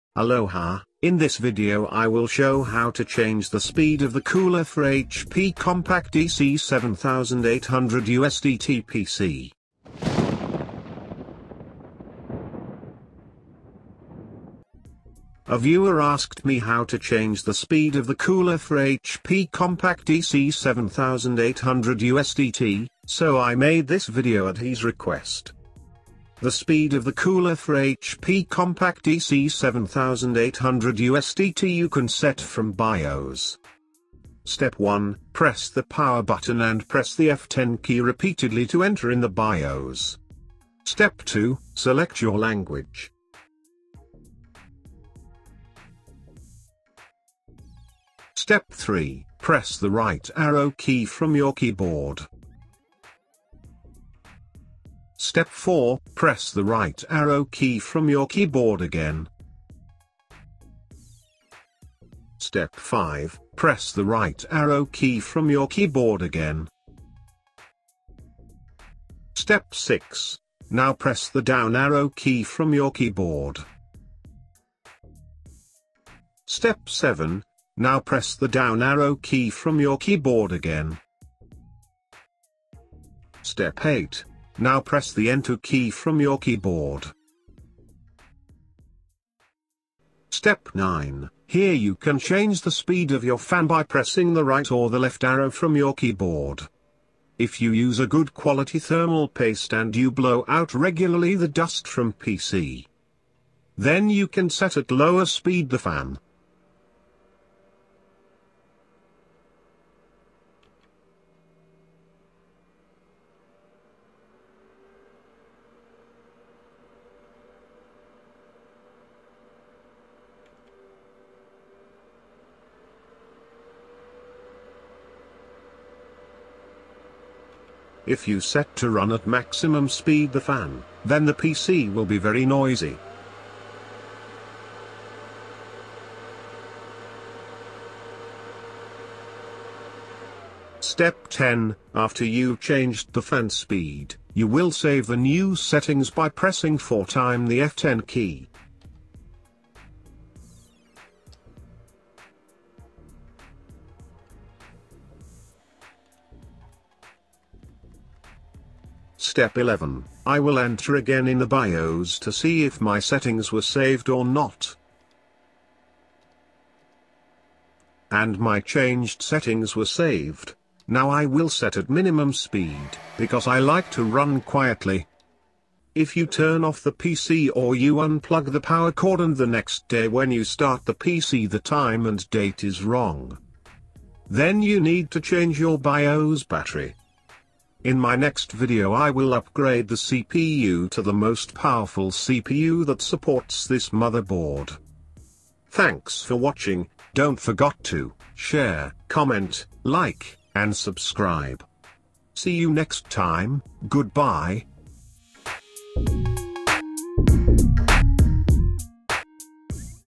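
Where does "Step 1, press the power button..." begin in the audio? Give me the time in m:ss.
0:34.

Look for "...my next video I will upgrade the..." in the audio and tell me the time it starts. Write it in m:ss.
3:07.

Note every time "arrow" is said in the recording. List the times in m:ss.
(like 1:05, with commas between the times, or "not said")
0:50, 0:57, 1:04, 1:11, 1:18, 1:35.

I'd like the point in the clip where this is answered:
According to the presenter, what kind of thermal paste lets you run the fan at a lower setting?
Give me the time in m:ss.
1:38.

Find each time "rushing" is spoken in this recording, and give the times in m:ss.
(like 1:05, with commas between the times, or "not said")
not said.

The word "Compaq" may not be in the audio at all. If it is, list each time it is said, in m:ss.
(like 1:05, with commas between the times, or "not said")
0:05, 0:19, 0:28.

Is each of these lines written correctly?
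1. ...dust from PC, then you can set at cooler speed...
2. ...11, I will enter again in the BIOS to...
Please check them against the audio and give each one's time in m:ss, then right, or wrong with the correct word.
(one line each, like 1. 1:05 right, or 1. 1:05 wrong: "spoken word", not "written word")
1. 1:41 wrong: "lower", not "cooler"
2. 2:39 right.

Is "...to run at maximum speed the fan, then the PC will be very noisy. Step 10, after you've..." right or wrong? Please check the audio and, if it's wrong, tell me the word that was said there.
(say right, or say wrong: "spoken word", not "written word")
right.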